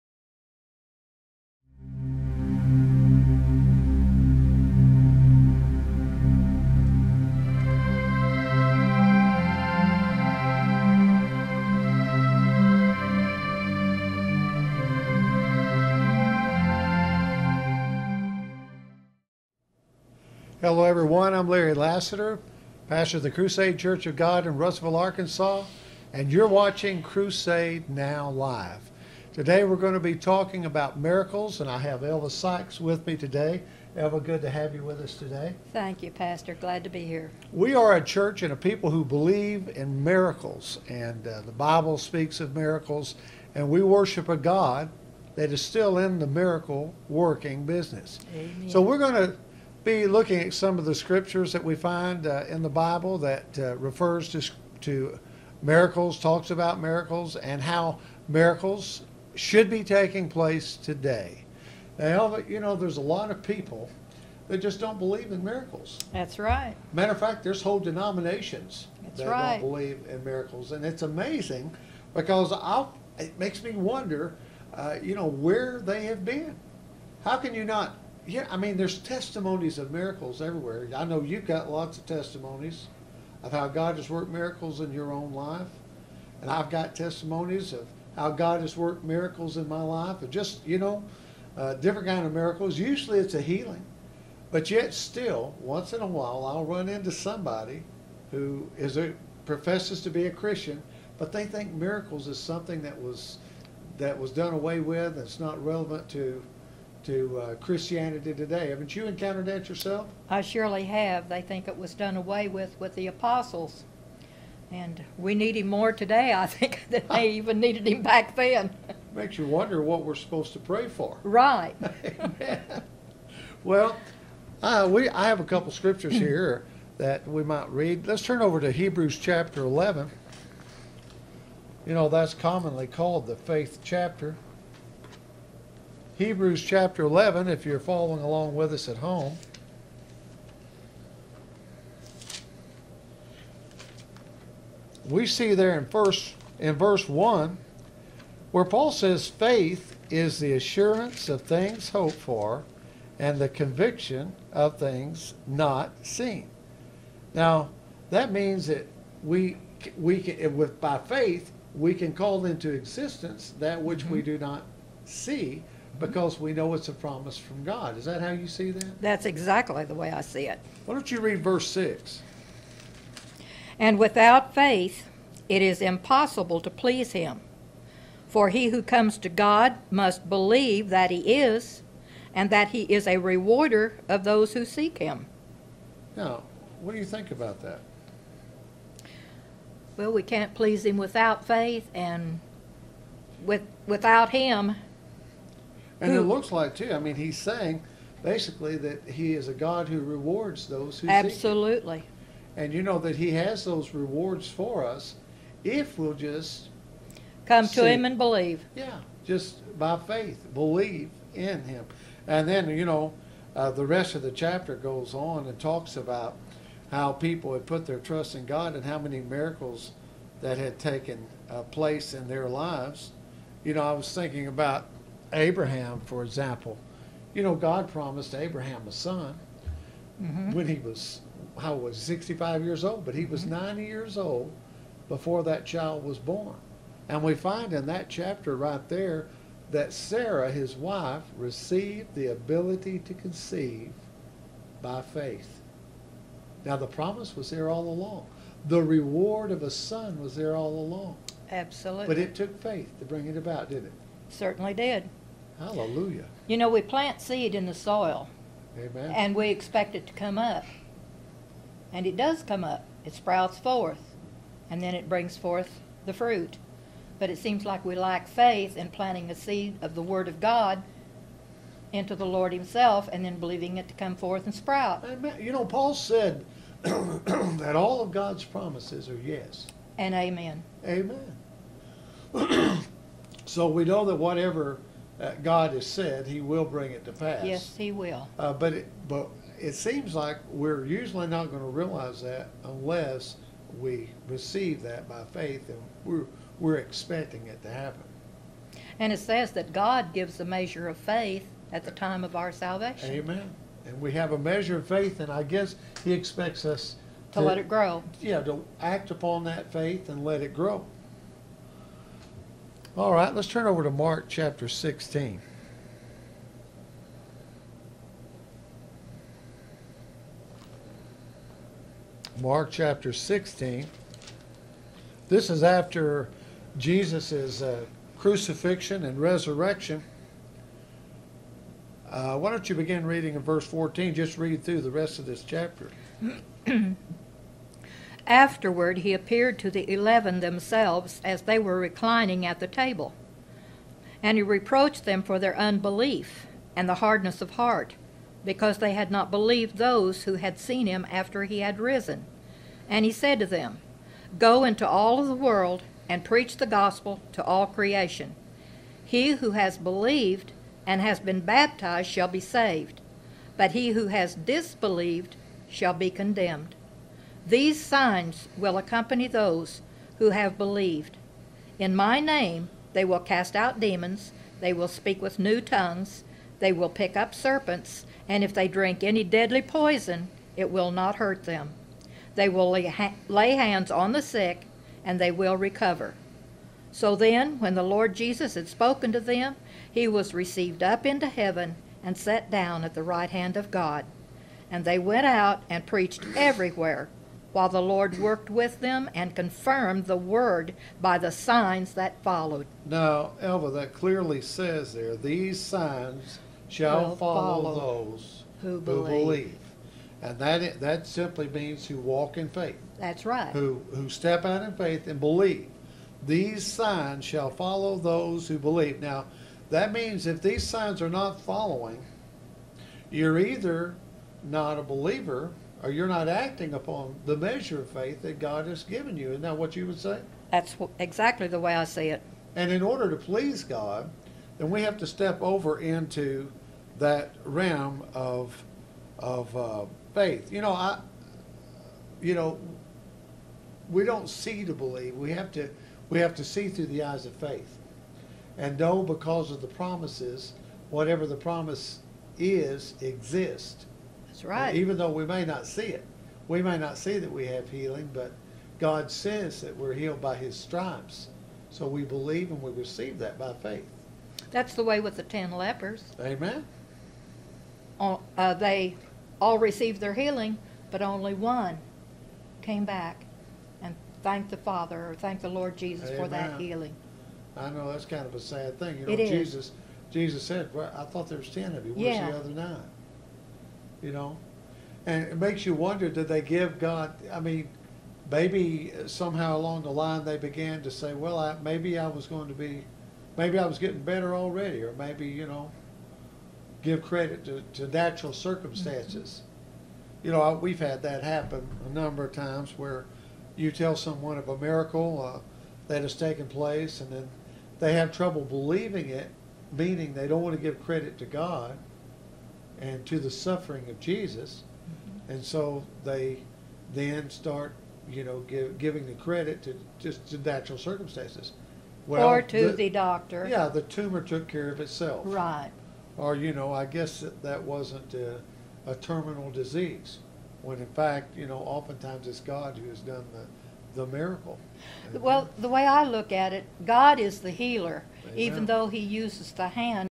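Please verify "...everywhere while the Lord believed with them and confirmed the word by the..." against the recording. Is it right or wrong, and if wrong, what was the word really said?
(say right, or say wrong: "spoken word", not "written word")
wrong: "worked", not "believed".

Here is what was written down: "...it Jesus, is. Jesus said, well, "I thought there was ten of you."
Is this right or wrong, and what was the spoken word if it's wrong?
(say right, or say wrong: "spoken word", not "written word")
right.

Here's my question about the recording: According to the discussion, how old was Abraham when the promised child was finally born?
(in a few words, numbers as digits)
90.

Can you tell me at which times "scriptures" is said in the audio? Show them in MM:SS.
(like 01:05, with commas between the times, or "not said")
00:50, 02:05.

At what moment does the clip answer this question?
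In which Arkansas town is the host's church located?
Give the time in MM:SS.
00:24.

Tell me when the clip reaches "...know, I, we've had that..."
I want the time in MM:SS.
08:20.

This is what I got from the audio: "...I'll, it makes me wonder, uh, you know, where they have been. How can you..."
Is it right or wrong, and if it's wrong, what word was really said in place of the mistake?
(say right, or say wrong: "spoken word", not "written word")
right.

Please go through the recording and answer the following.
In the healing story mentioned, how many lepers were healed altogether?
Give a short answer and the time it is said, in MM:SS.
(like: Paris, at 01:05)
10, at 07:45.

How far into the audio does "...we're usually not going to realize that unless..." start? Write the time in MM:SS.
04:50.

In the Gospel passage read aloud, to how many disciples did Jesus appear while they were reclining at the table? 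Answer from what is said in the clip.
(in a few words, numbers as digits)
11.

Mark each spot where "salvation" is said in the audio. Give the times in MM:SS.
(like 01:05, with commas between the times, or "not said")
05:02.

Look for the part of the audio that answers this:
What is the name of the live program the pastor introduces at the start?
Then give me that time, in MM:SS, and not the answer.
00:27.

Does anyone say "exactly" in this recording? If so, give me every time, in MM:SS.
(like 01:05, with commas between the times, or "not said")
02:49, 07:10.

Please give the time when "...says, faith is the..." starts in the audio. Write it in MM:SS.
02:28.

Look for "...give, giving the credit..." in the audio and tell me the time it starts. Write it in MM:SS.
08:38.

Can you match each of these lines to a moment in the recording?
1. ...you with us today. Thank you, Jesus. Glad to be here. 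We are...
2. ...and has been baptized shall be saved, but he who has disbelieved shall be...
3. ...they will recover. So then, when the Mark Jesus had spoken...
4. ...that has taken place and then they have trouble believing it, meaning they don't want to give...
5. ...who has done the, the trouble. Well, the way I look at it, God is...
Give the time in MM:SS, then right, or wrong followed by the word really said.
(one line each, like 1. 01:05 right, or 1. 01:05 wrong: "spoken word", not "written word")
1. 00:34 wrong: "Pastor", not "Jesus"
2. 06:00 right
3. 06:25 wrong: "Lord", not "Mark"
4. 08:25 right
5. 08:52 wrong: "miracle", not "trouble".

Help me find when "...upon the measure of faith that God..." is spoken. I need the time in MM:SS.
07:06.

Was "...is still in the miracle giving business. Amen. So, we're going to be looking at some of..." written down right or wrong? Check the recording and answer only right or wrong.
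wrong.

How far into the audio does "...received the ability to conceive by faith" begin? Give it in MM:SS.
04:01.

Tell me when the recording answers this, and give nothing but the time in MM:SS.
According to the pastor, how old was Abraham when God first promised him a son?
03:51.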